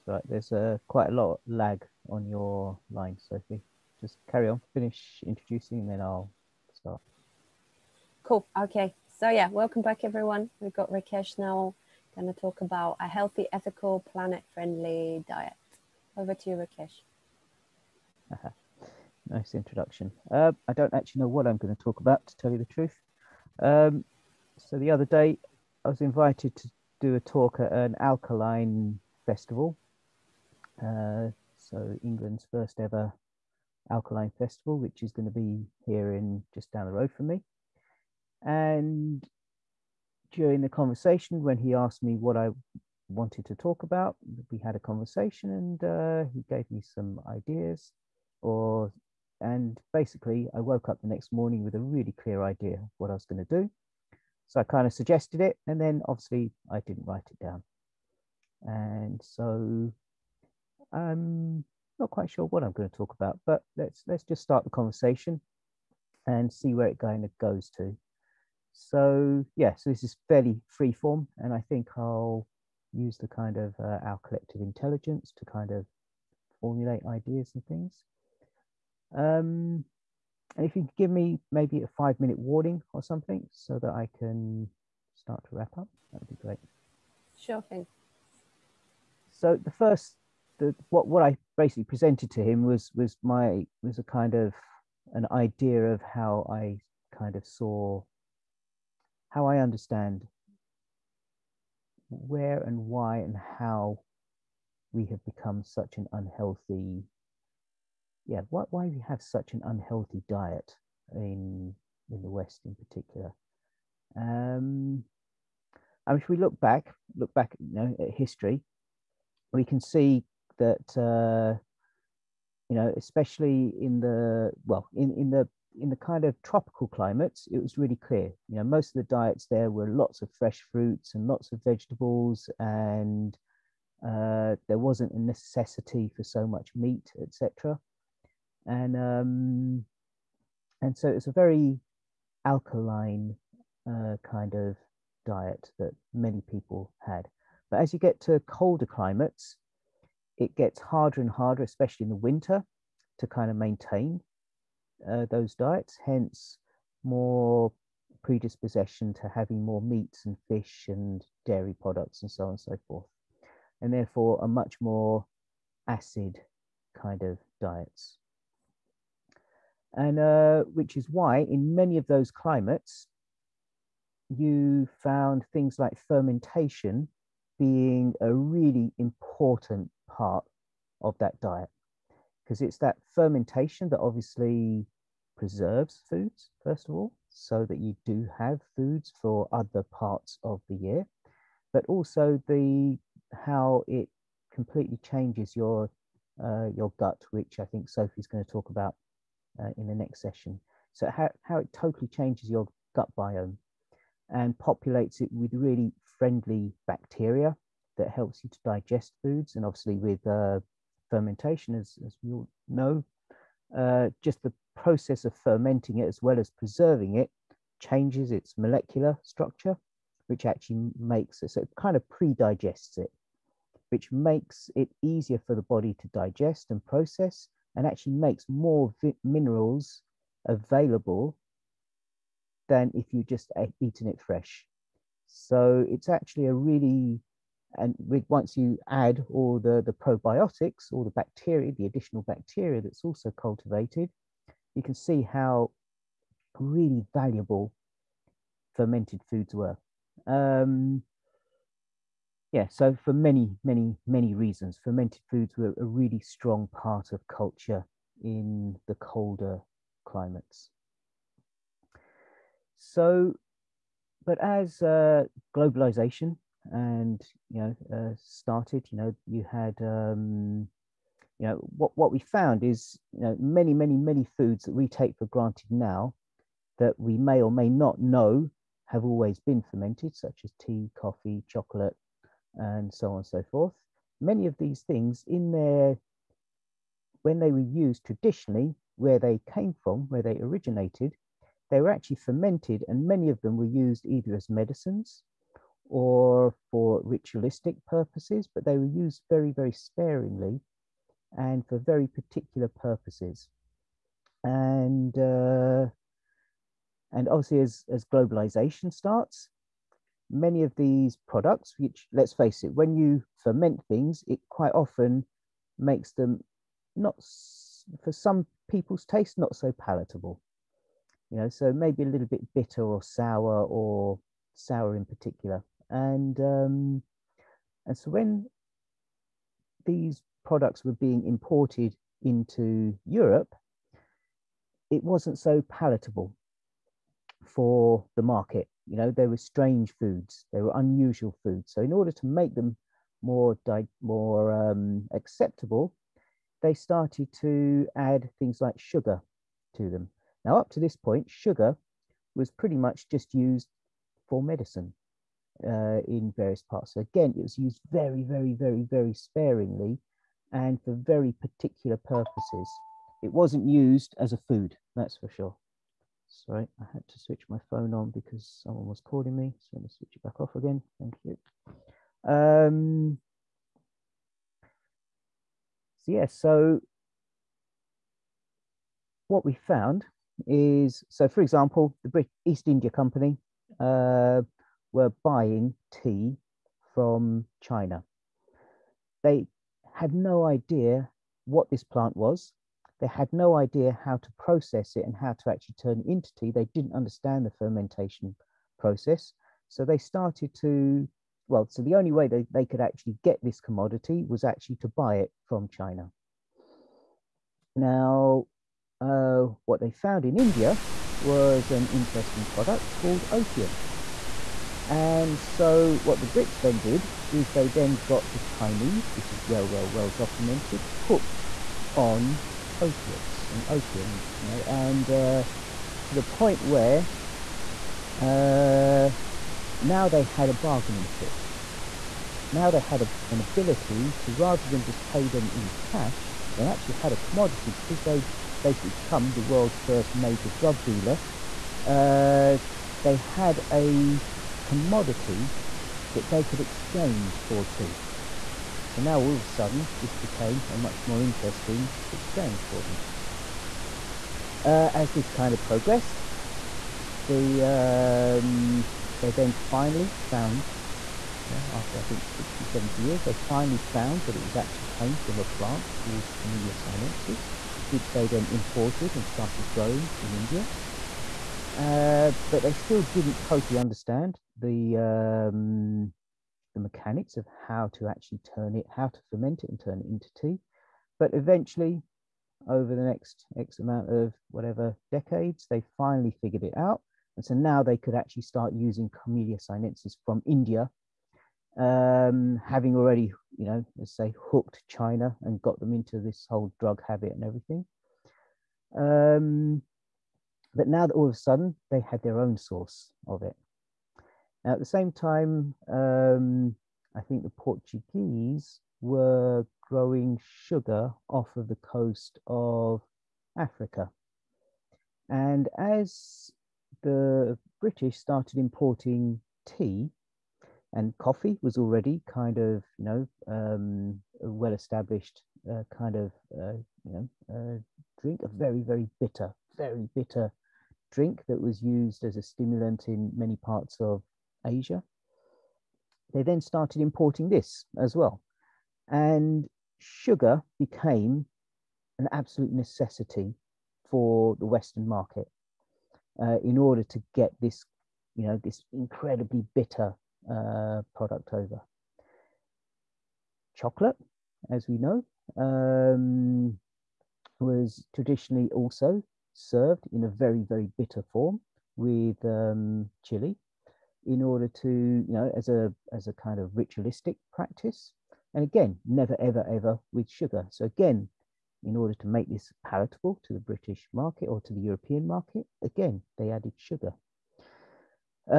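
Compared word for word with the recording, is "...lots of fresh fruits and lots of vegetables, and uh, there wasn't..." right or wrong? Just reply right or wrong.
right.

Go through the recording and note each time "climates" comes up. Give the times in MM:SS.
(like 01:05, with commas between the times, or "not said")
02:06, 02:28, 02:52, 04:20.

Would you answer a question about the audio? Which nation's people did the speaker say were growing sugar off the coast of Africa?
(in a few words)
Portuguese.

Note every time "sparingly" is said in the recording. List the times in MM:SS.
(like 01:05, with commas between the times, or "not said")
04:59, 05:59.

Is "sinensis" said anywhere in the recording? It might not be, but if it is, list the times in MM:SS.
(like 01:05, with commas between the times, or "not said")
07:46, 08:09.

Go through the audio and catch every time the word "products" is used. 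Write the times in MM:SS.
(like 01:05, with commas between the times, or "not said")
02:41, 05:11, 05:30, 06:52, 09:11.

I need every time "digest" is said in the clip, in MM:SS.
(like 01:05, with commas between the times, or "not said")
03:28, 03:42, 03:46.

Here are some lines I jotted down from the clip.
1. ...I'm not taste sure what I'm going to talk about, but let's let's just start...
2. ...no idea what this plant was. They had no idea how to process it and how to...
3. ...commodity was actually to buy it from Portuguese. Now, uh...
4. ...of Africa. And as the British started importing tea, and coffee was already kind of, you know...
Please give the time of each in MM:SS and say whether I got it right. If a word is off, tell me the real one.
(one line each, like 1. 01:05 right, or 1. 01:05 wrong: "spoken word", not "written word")
1. 01:00 wrong: "quite", not "taste"
2. 06:30 right
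3. 06:43 wrong: "China", not "Portuguese"
4. 08:32 right.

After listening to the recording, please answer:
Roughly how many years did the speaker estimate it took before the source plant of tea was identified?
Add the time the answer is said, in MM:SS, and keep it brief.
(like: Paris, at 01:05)
60-70 years, at 07:42.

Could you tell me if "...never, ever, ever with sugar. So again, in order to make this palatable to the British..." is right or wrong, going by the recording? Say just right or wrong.
right.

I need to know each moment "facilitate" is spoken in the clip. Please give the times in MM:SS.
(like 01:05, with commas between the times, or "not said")
not said.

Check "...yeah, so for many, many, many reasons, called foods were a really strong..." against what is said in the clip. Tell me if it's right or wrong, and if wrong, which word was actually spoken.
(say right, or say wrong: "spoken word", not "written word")
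wrong: "fermented", not "called".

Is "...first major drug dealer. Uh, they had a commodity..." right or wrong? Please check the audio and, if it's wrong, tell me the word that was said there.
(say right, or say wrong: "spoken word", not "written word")
right.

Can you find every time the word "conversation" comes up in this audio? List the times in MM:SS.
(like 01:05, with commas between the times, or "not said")
00:40, 00:44, 01:04.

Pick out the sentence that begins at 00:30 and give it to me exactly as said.
Uh, so England's first ever alkaline festival, which is going to be here in just down the road from me.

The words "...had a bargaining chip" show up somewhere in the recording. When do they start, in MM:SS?
07:10.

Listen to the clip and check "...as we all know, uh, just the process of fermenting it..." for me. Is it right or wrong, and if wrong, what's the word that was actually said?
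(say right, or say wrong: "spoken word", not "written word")
right.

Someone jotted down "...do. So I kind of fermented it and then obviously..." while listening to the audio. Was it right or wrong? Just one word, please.
wrong.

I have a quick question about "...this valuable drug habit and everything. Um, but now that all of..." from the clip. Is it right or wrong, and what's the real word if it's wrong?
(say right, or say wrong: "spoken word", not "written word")
wrong: "whole", not "valuable".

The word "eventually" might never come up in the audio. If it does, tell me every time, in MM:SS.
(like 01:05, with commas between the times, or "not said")
08:01.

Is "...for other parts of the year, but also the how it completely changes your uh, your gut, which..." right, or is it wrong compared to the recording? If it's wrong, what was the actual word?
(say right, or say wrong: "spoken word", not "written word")
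right.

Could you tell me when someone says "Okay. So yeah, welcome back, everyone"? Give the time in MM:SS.
00:08.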